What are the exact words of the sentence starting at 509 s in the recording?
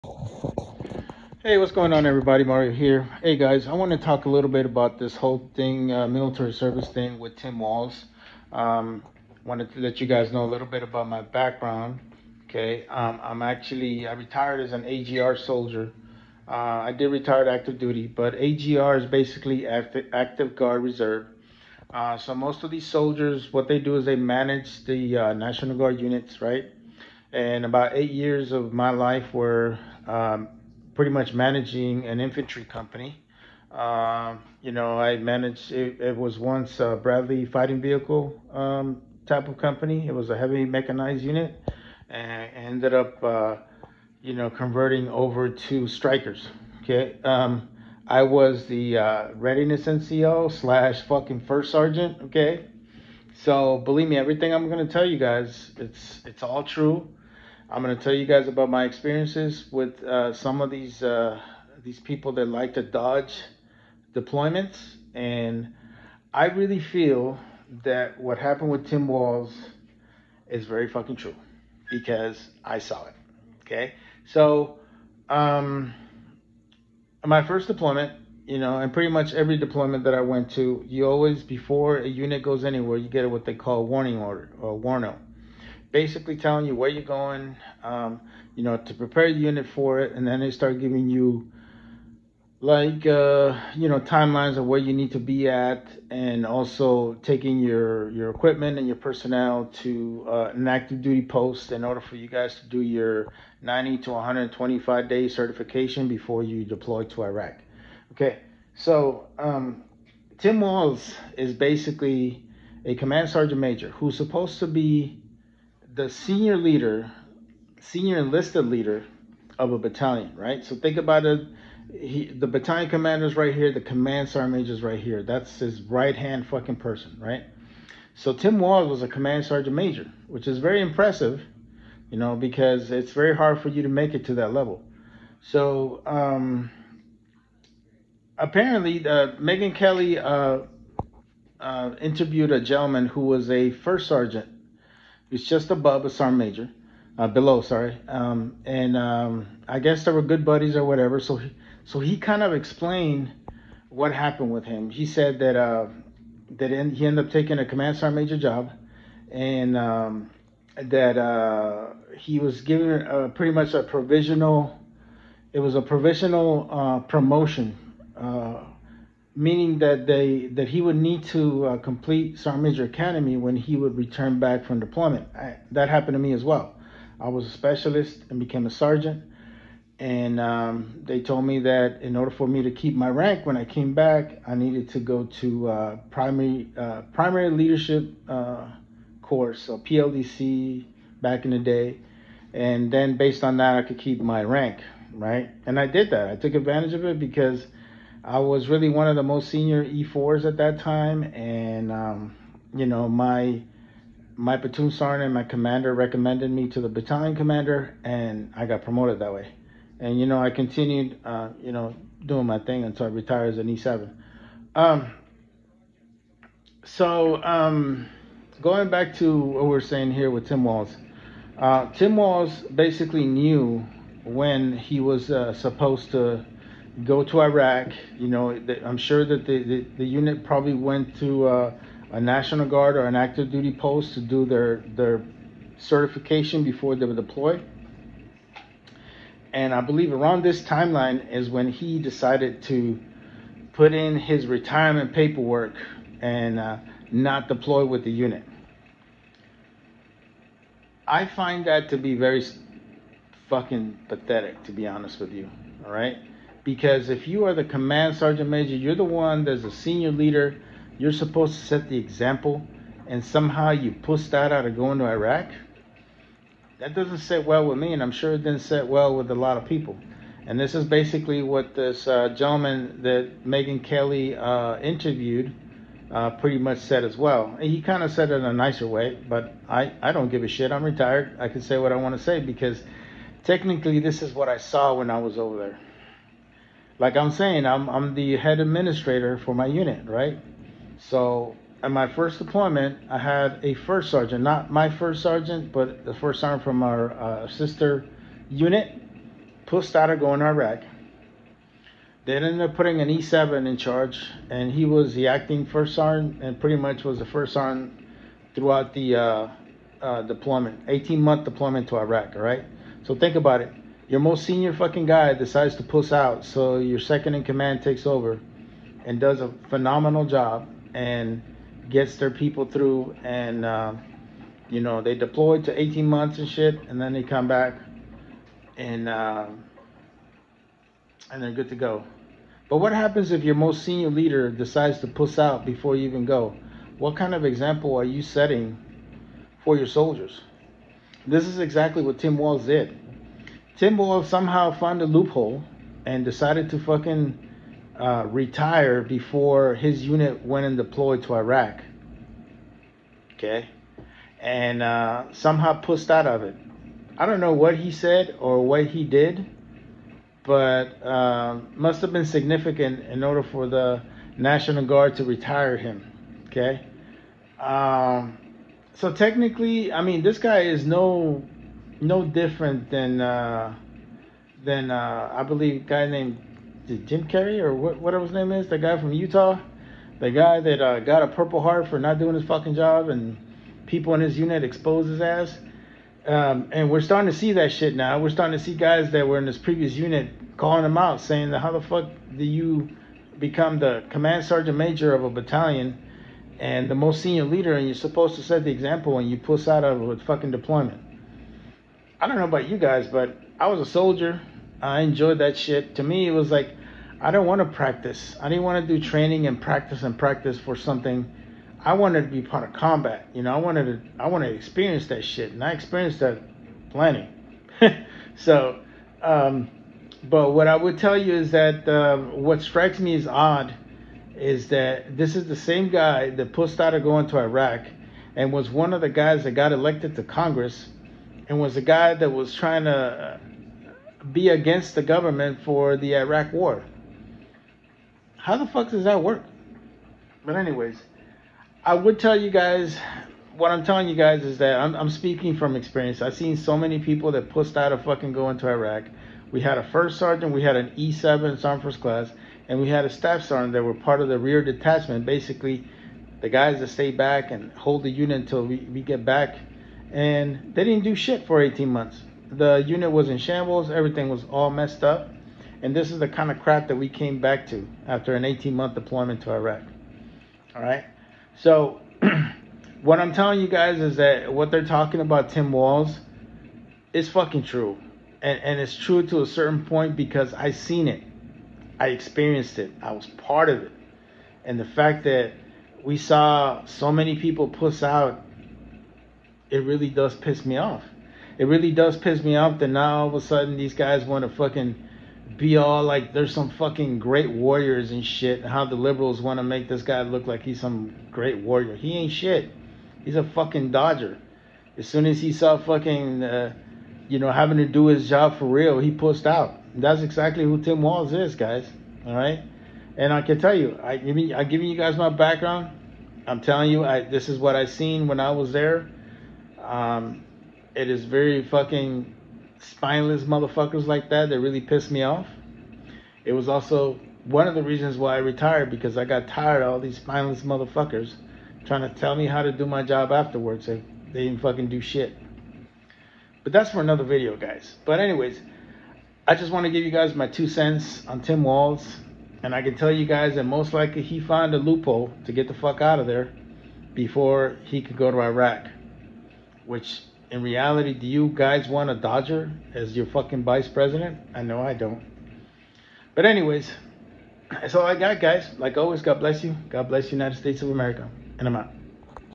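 And that's exactly who Tim Walz is, guys.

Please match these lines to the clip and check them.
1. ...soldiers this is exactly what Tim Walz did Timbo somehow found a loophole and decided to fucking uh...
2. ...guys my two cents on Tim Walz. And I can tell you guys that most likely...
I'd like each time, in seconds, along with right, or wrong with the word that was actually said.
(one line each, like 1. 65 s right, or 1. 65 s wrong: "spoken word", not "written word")
1. 339 s right
2. 540 s right.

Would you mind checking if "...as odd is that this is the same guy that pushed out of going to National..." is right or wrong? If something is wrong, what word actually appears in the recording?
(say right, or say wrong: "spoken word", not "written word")
wrong: "Iraq", not "National".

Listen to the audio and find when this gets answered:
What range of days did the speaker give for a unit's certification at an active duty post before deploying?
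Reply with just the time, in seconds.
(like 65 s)
103 s.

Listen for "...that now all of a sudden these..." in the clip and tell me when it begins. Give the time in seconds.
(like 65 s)
492 s.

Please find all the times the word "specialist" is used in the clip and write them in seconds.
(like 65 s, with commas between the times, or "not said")
177 s.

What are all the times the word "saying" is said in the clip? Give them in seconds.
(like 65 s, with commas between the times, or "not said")
219 s, 287 s, 391 s.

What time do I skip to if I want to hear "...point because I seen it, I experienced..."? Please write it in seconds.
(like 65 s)
479 s.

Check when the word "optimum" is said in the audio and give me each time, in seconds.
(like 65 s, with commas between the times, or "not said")
not said.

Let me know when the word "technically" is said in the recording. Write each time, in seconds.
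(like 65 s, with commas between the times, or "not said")
283 s, 369 s.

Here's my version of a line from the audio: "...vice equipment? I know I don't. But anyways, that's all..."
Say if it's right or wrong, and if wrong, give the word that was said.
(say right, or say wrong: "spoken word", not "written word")
wrong: "president", not "equipment".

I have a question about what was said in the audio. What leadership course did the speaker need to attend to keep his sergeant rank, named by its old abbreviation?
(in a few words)
PLDC.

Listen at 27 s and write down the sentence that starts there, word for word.
And about eight years of my life were um, pretty much managing an infantry company.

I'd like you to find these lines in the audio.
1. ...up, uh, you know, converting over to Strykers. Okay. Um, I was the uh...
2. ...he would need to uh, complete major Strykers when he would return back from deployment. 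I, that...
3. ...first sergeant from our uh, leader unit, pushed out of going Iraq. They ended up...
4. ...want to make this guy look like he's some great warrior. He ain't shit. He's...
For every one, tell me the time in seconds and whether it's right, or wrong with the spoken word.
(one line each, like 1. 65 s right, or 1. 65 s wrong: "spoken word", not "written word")
1. 42 s right
2. 170 s wrong: "Academy", not "Strykers"
3. 296 s wrong: "sister", not "leader"
4. 499 s right.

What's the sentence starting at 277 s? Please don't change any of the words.
And he kind of said it in a nicer way, but I, I don't give a shit.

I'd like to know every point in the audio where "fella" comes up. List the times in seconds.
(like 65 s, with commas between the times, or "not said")
not said.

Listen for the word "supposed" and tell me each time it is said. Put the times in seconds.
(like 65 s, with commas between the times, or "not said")
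114 s, 225 s, 261 s, 397 s.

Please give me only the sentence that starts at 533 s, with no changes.
They, they didn't fucking do shit.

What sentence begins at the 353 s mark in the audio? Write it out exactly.
Okay, and uh, somehow pushed out of it.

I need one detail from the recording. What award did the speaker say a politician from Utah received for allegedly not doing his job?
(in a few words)
Purple Heart.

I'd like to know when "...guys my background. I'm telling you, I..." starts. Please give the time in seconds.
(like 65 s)
514 s.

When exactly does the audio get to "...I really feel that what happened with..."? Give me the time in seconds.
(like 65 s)
66 s.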